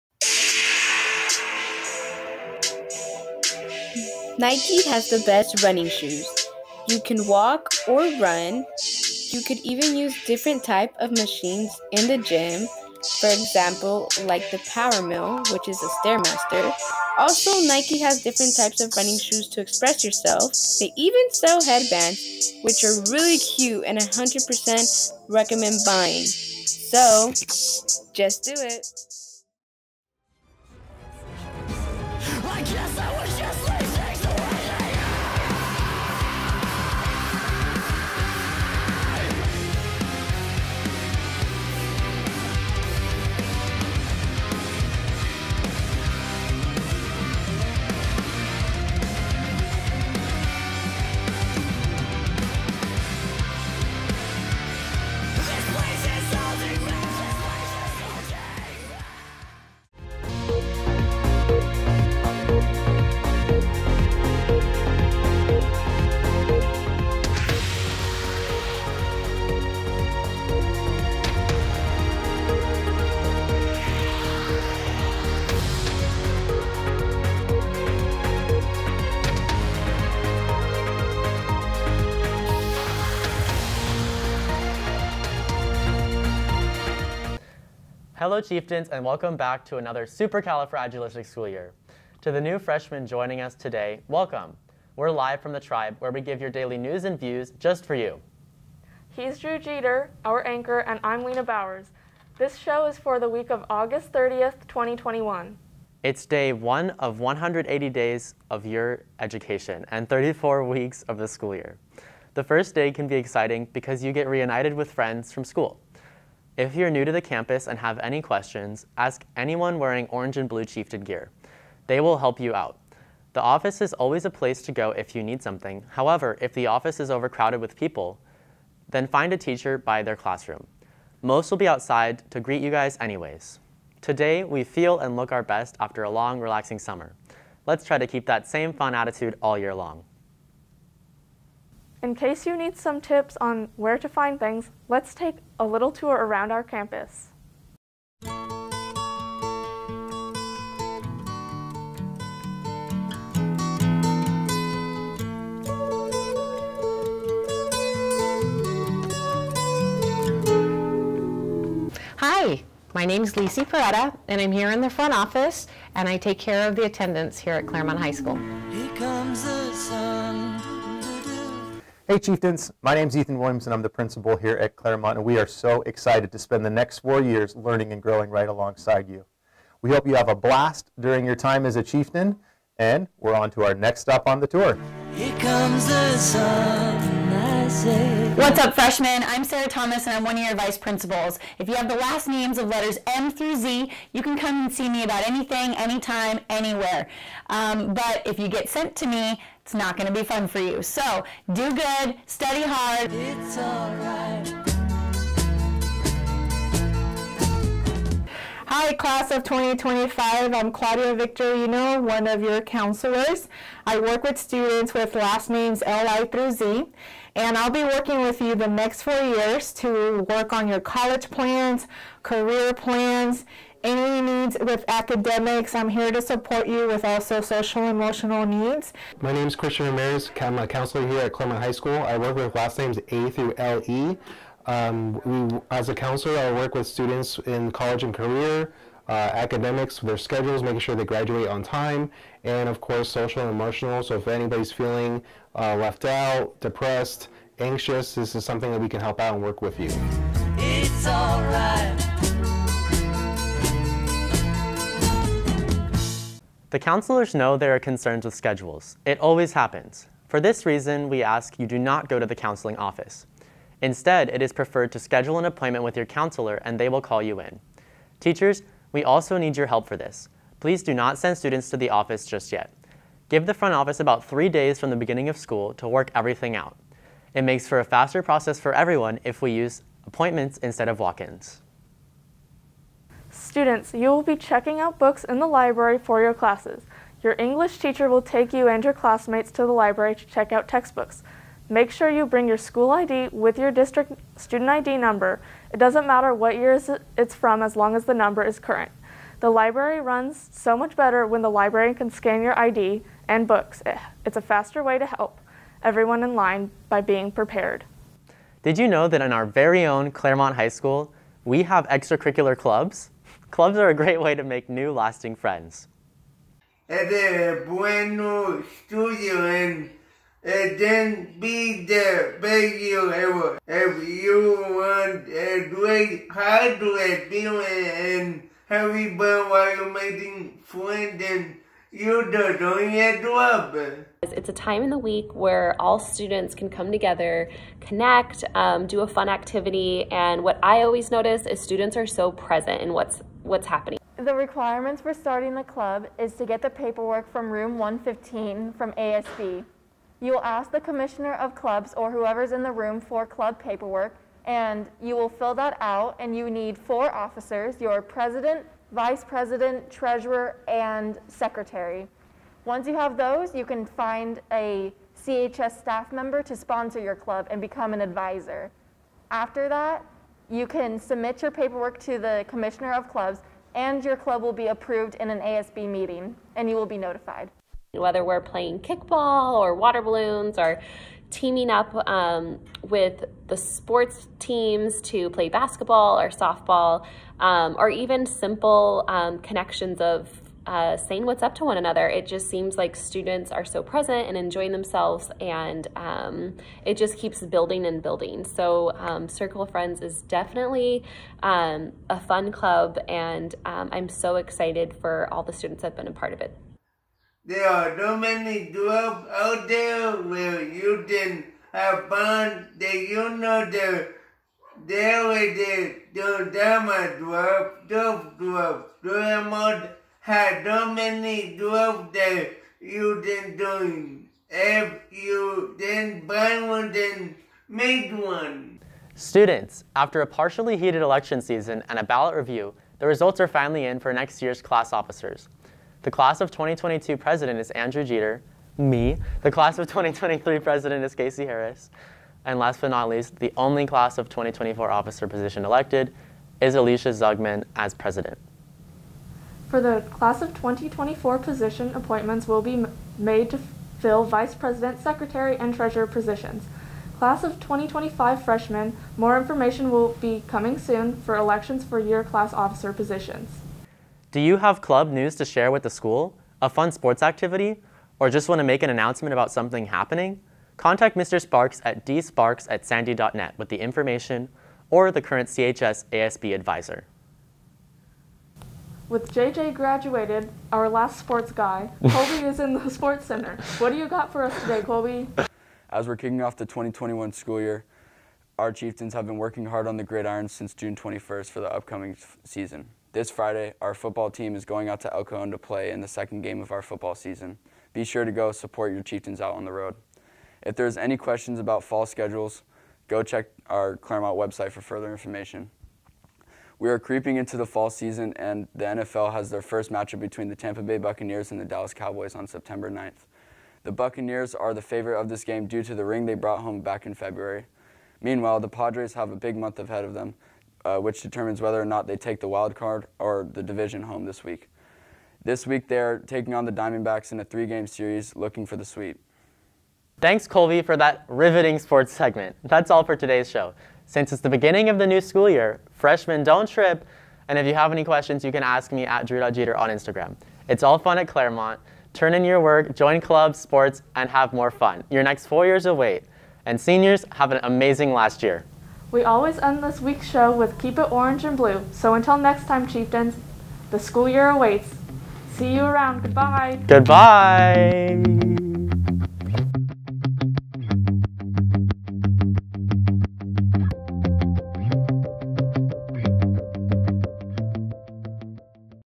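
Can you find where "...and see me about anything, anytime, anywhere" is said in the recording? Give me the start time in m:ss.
3:14.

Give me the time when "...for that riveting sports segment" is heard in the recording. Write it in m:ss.
8:50.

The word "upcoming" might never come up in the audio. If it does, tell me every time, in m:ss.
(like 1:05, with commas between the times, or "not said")
8:11.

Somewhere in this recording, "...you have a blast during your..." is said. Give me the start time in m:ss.
3:00.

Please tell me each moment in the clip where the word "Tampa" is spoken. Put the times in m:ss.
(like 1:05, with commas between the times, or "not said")
8:30.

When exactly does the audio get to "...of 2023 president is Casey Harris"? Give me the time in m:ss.
7:19.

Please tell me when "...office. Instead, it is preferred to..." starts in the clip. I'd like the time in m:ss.
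4:22.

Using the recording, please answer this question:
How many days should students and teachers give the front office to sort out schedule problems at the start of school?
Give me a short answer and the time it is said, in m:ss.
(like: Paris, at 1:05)
3, at 4:34.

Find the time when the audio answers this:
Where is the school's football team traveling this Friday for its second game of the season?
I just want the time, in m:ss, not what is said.
8:15.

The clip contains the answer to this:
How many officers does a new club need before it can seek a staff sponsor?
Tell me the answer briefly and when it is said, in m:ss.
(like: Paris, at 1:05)
4, at 5:56.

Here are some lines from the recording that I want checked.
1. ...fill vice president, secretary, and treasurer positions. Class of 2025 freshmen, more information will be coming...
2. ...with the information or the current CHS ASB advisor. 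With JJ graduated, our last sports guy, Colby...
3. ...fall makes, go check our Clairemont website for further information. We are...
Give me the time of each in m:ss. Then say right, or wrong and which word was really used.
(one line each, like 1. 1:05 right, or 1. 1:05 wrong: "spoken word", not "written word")
1. 7:33 right
2. 7:53 right
3. 8:21 wrong: "schedules", not "makes".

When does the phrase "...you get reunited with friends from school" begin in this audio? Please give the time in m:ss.
1:54.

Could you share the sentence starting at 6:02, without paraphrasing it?
Once you have those, you can find a CHS staff member to sponsor your club and become an advisor.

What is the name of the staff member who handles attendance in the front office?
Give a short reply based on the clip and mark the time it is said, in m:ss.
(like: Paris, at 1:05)
Lisi Peretta, at 2:43.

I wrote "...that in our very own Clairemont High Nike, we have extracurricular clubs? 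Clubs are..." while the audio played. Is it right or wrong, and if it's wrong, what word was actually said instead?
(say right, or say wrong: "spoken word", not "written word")
wrong: "School", not "Nike".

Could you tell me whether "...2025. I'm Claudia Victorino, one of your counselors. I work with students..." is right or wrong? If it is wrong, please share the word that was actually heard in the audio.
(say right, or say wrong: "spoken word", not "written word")
right.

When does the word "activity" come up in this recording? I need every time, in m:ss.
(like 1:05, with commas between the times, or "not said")
5:39, 7:47.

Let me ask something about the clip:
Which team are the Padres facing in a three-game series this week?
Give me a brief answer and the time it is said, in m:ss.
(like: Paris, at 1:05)
Diamondbacks, at 8:46.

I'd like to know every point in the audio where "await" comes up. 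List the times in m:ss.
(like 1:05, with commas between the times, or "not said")
9:05, 9:14.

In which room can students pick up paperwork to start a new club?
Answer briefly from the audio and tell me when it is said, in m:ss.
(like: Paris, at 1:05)
Room 115, at 5:47.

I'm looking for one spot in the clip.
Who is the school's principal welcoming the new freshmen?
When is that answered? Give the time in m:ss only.
2:53.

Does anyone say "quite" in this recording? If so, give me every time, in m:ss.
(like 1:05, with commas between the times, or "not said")
not said.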